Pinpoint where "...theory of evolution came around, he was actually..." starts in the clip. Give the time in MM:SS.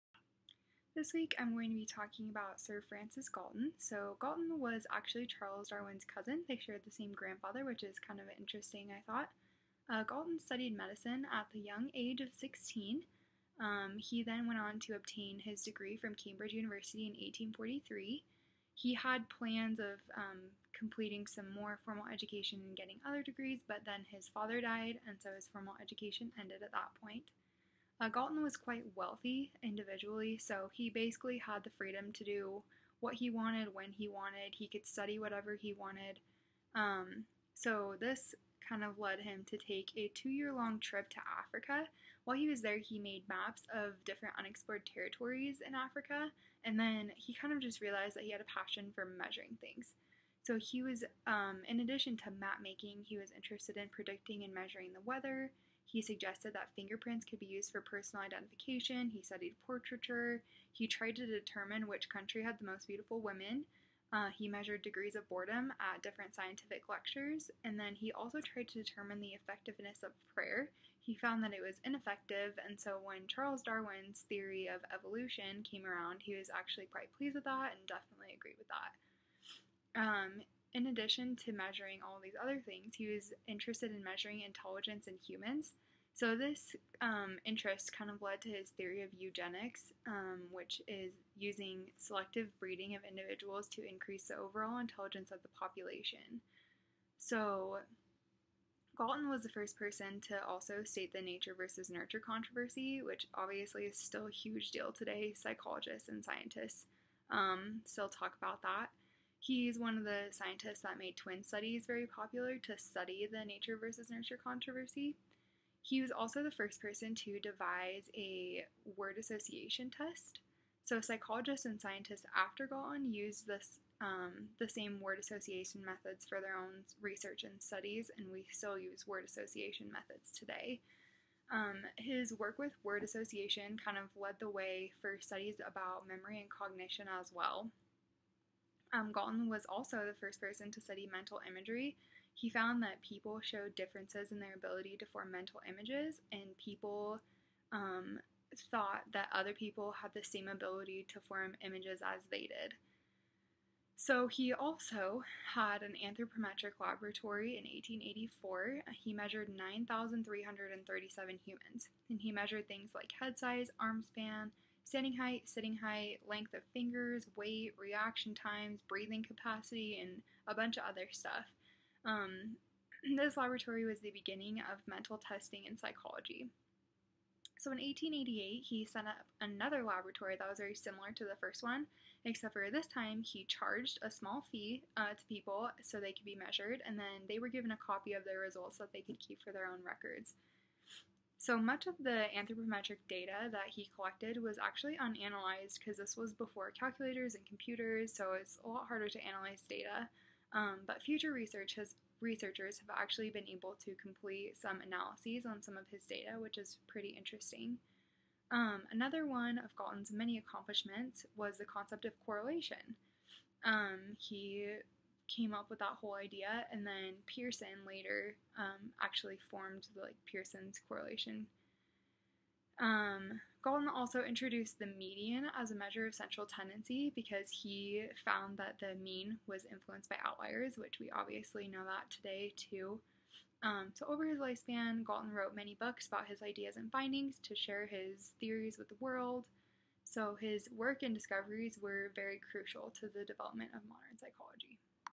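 01:14.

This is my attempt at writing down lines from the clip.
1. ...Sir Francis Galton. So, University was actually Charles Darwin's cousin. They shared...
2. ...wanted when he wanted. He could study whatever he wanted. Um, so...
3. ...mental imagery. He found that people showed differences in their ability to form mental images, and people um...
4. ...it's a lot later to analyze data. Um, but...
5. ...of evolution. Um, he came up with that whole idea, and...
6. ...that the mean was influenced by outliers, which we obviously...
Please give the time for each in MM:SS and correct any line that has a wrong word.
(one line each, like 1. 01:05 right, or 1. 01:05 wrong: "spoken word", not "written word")
1. 00:02 wrong: "Galton", not "University"
2. 00:33 right
3. 02:21 right
4. 03:18 wrong: "harder", not "later"
5. 03:32 wrong: "correlation", not "evolution"
6. 03:48 right.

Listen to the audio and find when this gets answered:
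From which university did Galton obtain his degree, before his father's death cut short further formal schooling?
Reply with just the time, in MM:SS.
00:16.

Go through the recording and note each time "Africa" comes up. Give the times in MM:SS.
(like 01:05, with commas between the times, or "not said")
00:41, 00:45.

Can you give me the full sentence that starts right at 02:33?
So he also had an anthropometric laboratory in 1884.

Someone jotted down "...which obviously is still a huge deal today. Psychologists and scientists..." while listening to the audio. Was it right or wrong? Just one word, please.
right.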